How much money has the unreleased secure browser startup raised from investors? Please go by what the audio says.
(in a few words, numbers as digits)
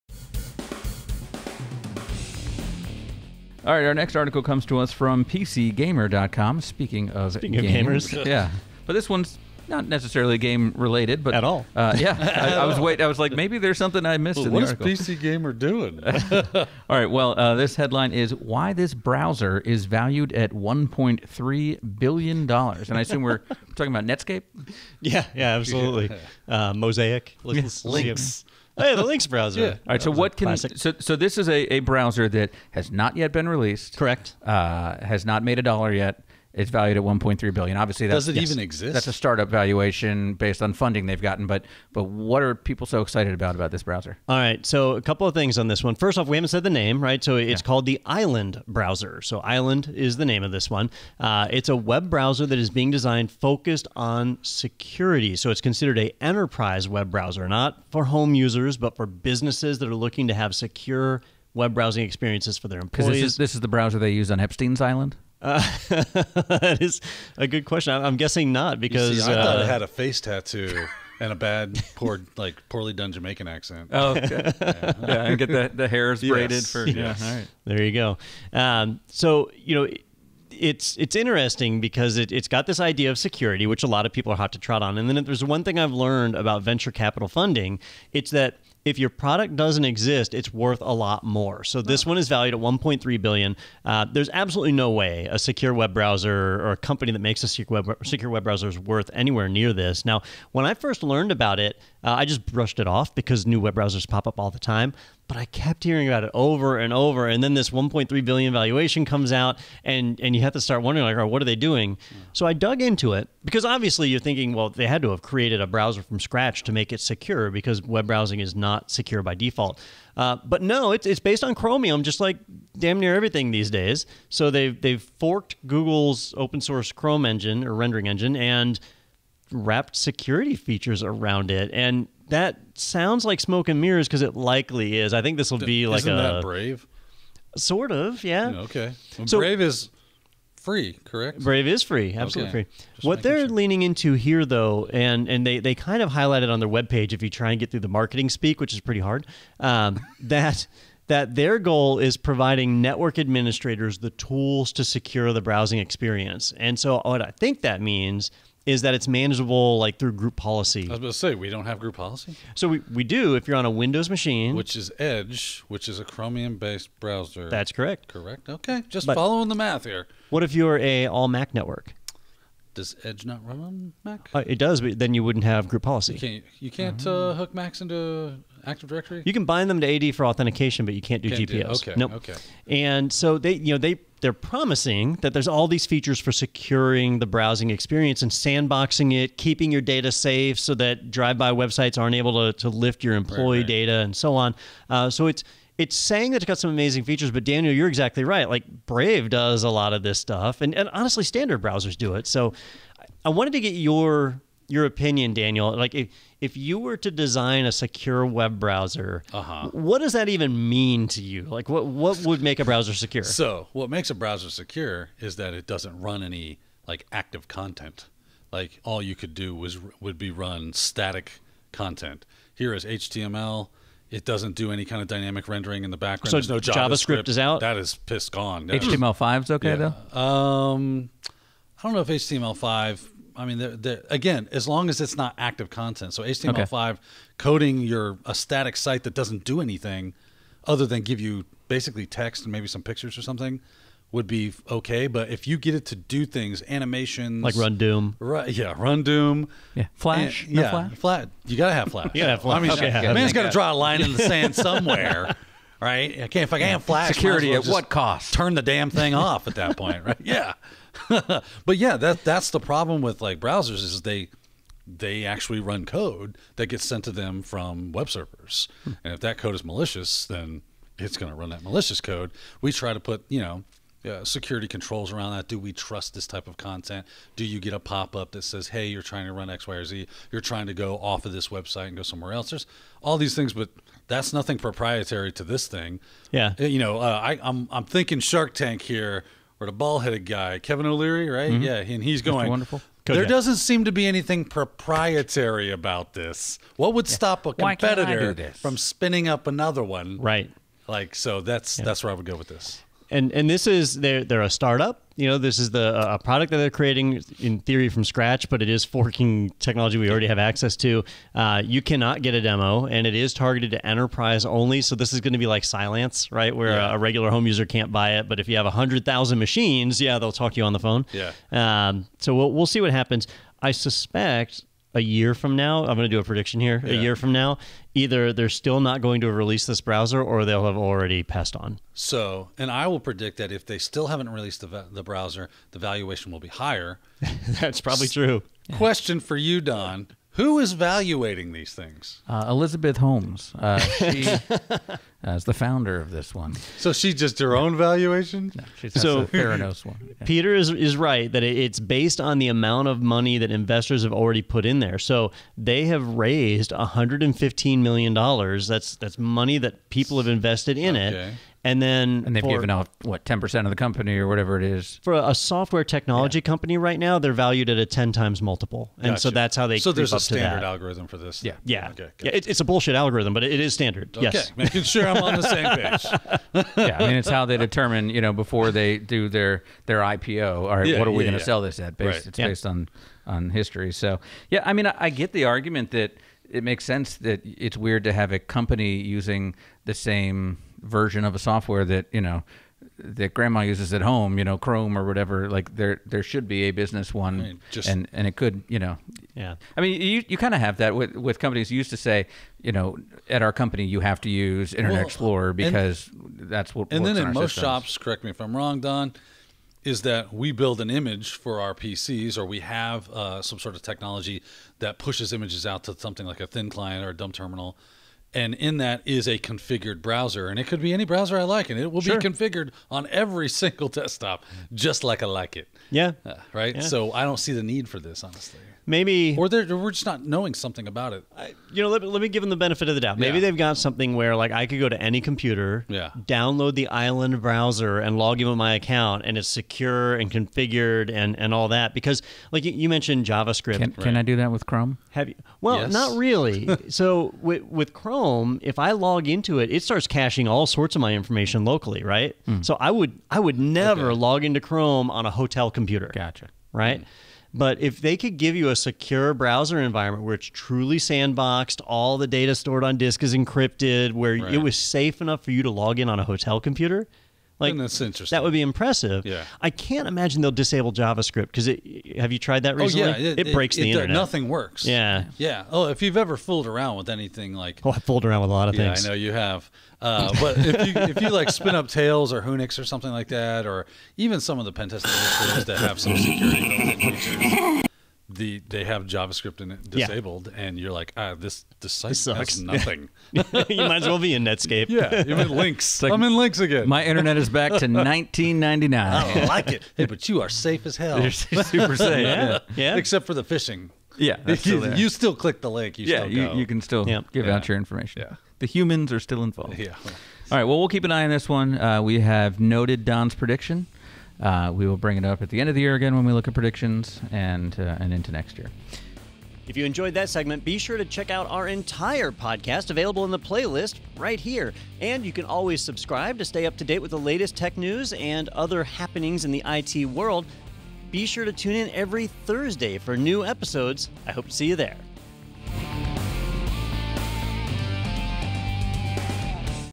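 $115 million.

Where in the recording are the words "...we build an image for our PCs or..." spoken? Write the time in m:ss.
6:50.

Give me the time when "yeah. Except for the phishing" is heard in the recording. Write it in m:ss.
8:22.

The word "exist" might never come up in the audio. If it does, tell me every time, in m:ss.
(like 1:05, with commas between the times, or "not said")
0:38, 1:29.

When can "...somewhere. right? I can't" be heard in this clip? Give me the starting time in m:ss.
4:14.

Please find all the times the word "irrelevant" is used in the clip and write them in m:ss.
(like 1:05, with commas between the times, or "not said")
not said.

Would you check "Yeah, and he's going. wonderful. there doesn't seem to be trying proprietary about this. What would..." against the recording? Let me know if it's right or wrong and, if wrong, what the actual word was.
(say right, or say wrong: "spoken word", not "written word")
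wrong: "anything", not "trying".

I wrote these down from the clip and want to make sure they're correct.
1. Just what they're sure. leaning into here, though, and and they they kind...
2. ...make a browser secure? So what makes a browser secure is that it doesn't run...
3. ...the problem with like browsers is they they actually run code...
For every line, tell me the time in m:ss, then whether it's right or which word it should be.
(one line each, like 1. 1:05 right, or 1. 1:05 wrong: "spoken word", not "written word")
1. 2:22 right
2. 3:32 right
3. 4:22 right.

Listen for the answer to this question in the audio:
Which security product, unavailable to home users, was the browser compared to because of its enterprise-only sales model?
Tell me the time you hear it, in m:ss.
5:15.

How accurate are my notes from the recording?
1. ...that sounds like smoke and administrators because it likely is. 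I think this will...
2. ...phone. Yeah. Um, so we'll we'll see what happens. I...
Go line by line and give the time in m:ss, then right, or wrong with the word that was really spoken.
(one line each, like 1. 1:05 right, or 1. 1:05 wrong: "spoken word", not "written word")
1. 2:12 wrong: "mirrors", not "administrators"
2. 5:20 right.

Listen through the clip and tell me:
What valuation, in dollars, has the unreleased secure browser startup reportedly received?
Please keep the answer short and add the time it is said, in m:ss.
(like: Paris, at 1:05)
1.3 billion, at 0:20.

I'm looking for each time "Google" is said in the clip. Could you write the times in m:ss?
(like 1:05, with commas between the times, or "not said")
2:05.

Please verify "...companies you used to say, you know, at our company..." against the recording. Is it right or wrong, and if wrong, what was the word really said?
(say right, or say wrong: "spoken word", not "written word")
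right.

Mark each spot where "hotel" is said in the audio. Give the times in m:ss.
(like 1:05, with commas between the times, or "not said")
7:35, 7:46.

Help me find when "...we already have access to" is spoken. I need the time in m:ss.
5:09.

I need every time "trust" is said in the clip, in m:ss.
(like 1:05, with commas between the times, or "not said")
4:35.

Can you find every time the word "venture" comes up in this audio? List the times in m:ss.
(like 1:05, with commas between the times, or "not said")
1:26.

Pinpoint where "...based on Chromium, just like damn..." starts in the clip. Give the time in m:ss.
2:01.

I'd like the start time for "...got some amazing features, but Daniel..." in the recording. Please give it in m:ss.
3:16.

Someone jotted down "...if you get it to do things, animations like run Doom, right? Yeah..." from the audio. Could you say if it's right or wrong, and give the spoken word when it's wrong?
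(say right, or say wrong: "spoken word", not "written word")
right.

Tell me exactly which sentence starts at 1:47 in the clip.
And then this 1.3 billion valuation comes out, and and you have to start wondering like, what are they doing?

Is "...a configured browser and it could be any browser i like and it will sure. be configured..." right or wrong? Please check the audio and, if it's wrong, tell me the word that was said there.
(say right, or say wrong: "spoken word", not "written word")
right.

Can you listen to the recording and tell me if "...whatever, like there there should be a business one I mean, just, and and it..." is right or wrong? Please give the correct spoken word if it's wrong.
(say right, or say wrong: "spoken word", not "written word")
right.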